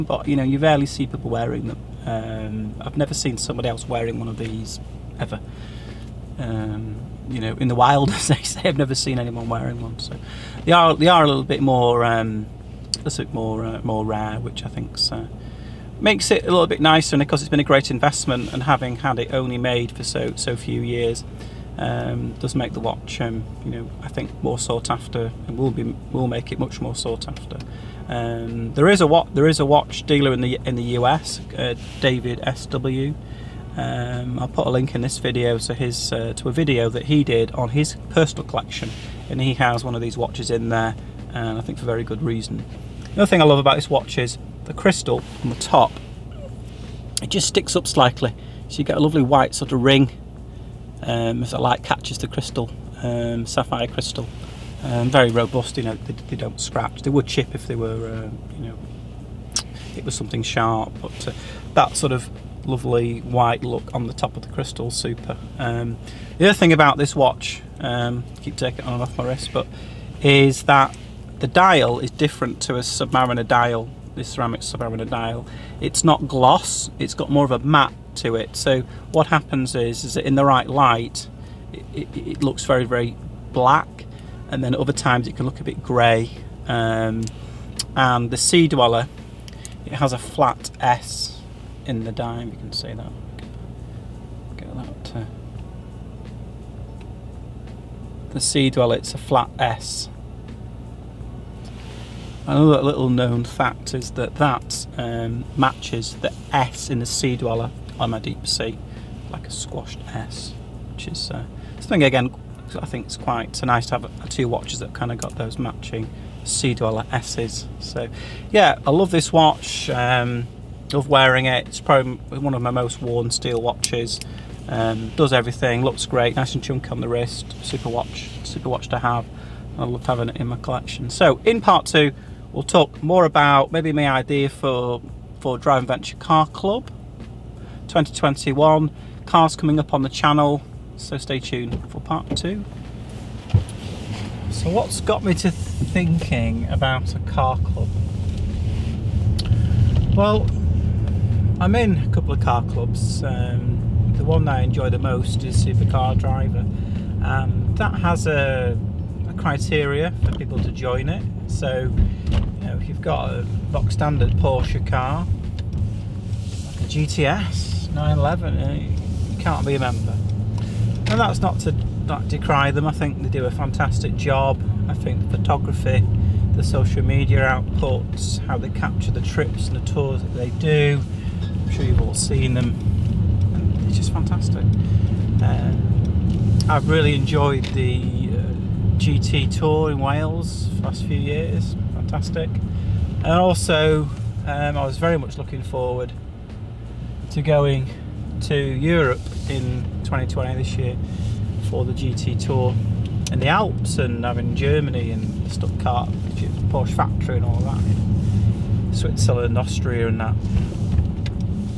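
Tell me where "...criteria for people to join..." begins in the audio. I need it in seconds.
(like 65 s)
159 s.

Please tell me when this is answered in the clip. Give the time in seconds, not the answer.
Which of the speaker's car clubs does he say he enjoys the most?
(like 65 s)
155 s.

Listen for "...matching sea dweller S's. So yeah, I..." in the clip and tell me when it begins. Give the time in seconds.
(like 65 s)
115 s.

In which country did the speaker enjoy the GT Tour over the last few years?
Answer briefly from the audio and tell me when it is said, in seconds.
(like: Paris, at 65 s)
Wales, at 189 s.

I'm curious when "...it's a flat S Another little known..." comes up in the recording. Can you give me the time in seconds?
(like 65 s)
98 s.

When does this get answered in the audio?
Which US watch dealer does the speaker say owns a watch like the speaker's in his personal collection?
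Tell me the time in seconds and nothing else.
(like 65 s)
32 s.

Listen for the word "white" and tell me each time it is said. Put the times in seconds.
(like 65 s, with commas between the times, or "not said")
49 s, 63 s.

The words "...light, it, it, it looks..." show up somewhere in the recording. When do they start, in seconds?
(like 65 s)
80 s.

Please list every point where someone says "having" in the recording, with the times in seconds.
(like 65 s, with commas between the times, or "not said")
18 s, 130 s, 204 s.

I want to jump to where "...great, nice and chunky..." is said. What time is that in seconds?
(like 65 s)
126 s.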